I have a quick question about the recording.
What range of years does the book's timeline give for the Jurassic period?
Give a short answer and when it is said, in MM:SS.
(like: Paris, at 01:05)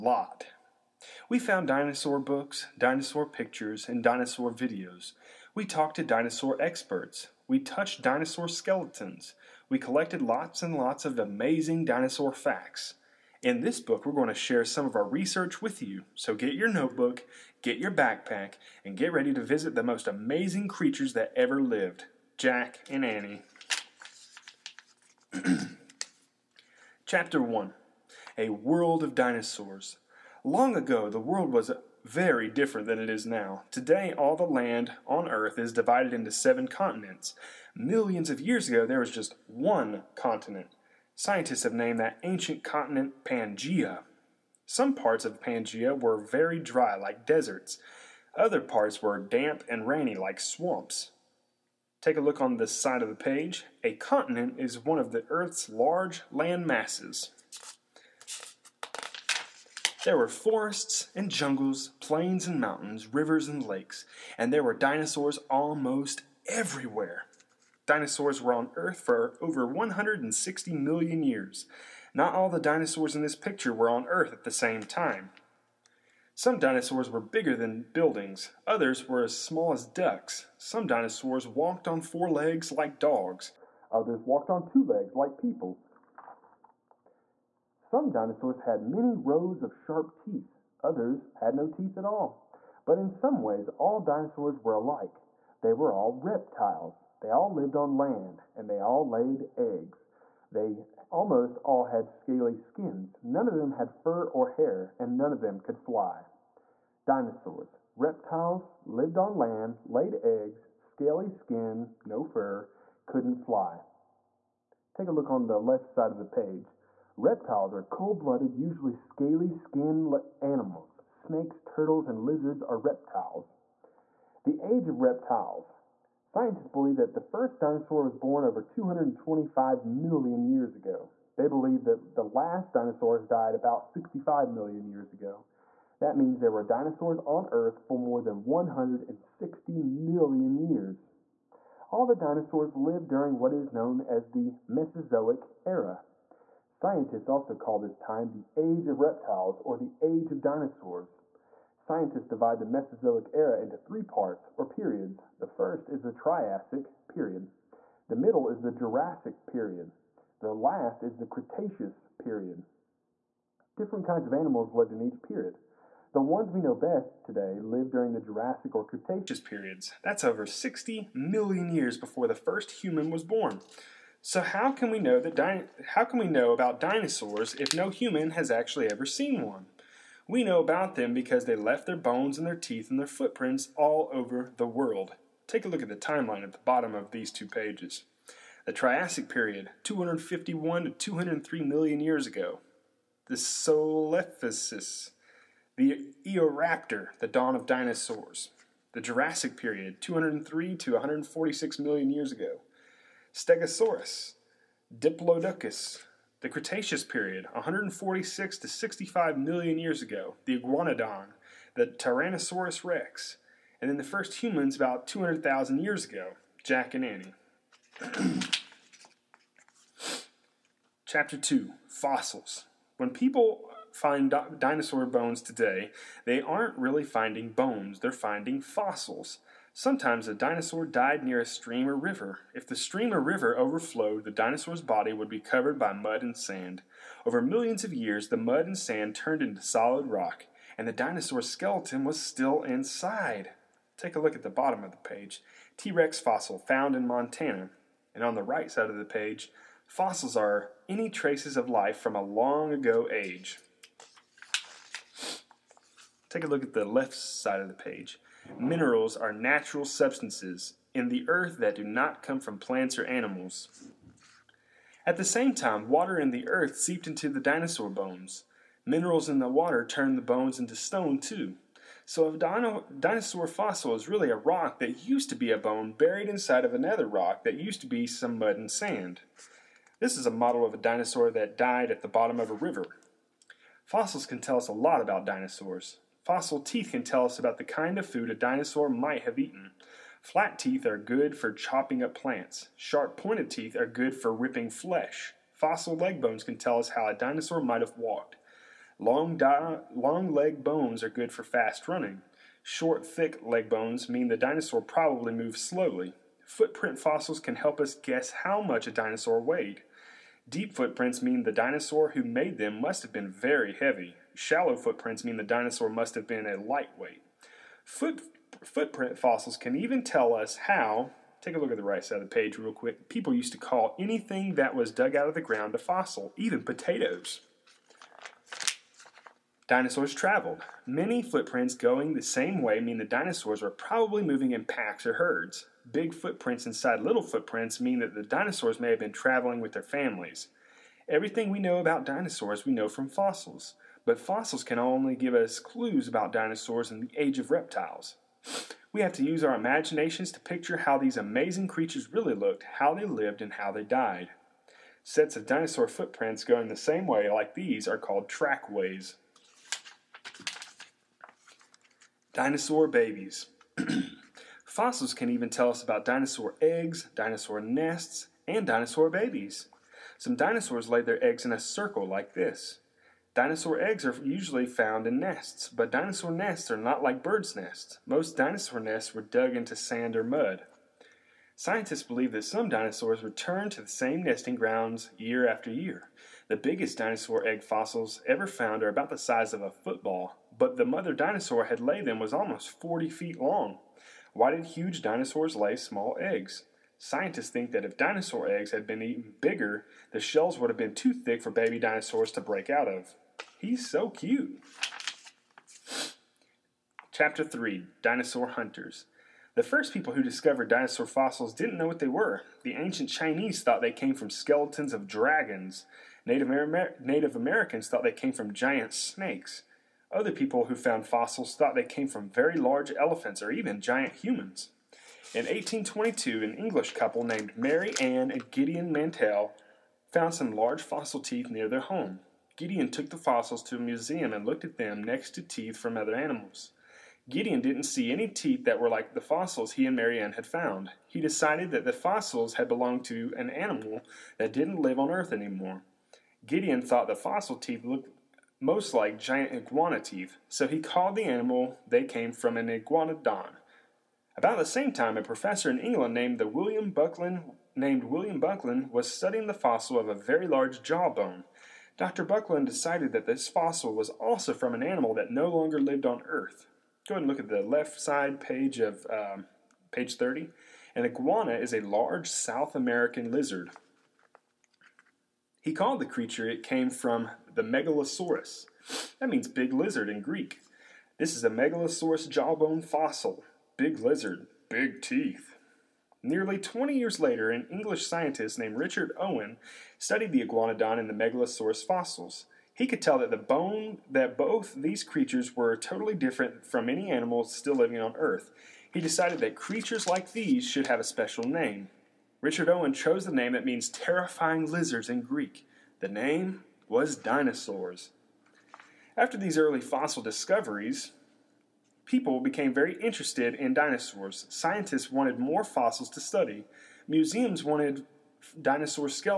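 203 to 146 million years ago, at 03:20.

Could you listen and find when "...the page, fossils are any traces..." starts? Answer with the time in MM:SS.
04:08.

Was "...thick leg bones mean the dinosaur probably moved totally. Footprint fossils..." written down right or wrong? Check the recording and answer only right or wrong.
wrong.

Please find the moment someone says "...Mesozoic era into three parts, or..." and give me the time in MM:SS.
02:32.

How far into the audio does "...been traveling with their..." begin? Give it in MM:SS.
05:38.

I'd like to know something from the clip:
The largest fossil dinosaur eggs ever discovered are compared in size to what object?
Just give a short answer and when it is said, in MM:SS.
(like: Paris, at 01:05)
a football, at 06:29.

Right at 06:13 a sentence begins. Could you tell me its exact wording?
Dinosaur eggs are usually found in nests, but dinosaur nests are not like birds' nests.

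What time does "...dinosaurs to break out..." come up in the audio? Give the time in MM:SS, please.
06:41.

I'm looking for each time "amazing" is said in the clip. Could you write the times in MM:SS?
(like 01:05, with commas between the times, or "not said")
00:11, 00:20, 05:51.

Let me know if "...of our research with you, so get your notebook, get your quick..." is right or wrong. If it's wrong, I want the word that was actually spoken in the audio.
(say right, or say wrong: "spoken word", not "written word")
wrong: "backpack", not "quick".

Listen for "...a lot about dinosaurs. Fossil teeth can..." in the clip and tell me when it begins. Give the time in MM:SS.
04:44.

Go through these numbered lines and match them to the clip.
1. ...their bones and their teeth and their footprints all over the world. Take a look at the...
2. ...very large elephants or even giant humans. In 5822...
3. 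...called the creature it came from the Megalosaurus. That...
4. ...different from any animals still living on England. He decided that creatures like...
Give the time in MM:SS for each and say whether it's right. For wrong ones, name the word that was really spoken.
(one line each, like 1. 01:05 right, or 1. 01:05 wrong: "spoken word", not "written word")
1. 03:01 right
2. 07:02 wrong: "1822", not "5822"
3. 07:55 right
4. 08:16 wrong: "Earth", not "England".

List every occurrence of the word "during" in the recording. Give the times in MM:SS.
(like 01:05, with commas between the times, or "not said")
02:23, 02:47.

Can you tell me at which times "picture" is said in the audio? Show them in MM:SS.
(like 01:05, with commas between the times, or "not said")
00:03, 01:13, 05:50.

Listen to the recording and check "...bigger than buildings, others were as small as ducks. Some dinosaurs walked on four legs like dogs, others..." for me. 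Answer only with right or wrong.
right.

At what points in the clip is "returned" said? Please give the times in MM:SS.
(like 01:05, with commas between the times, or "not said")
06:23.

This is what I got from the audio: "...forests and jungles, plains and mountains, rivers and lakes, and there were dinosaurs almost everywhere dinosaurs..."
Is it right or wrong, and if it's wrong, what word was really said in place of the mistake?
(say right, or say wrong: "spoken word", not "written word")
right.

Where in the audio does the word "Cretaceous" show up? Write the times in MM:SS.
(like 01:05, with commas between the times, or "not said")
02:41, 02:48, 03:26.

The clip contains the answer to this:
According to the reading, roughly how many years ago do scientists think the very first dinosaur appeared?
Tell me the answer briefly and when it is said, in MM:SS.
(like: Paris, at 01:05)
over 225 million years, at 02:08.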